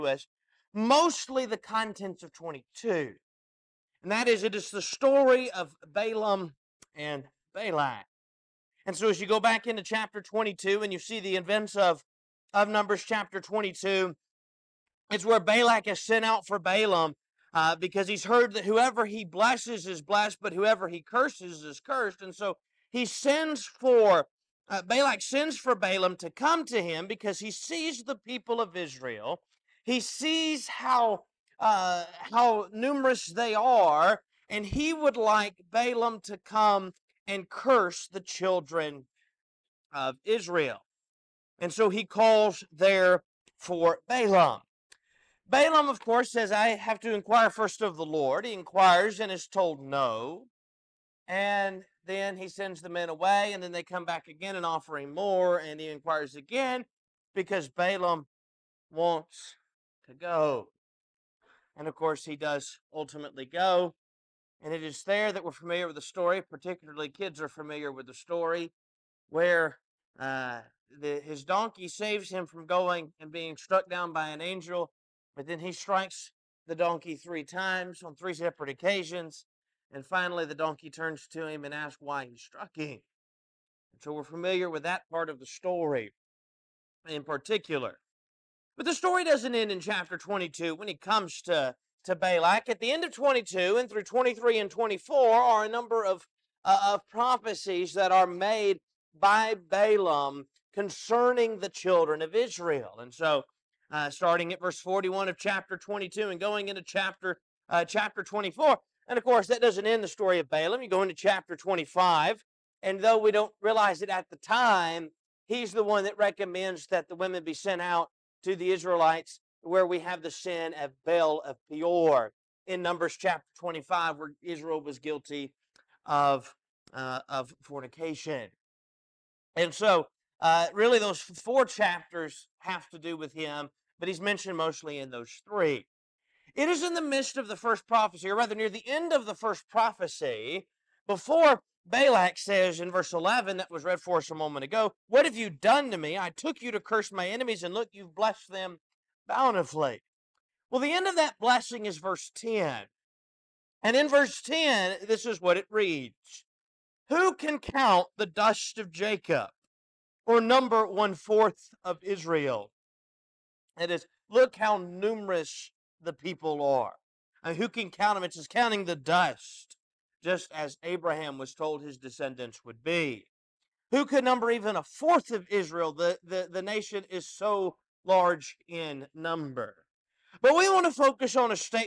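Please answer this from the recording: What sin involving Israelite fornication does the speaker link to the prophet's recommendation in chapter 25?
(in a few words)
Baal of Peor.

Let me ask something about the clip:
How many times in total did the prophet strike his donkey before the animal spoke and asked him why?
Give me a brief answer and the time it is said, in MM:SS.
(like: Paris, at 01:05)
3, at 01:17.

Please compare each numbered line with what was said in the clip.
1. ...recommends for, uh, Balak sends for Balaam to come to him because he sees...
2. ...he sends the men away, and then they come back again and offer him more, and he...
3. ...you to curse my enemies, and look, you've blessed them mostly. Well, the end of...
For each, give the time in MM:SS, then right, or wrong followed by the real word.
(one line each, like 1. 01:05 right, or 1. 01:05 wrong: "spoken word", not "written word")
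1. 00:23 wrong: "sends", not "recommends"
2. 00:52 right
3. 02:26 wrong: "bountifully", not "mostly".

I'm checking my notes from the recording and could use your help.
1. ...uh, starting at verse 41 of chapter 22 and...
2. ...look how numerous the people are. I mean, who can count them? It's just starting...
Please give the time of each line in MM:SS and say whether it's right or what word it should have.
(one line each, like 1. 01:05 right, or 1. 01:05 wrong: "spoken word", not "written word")
1. 01:43 right
2. 02:44 wrong: "counting", not "starting".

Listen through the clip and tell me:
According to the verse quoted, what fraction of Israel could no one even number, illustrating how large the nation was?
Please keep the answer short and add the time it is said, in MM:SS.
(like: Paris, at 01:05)
one fourth, at 02:40.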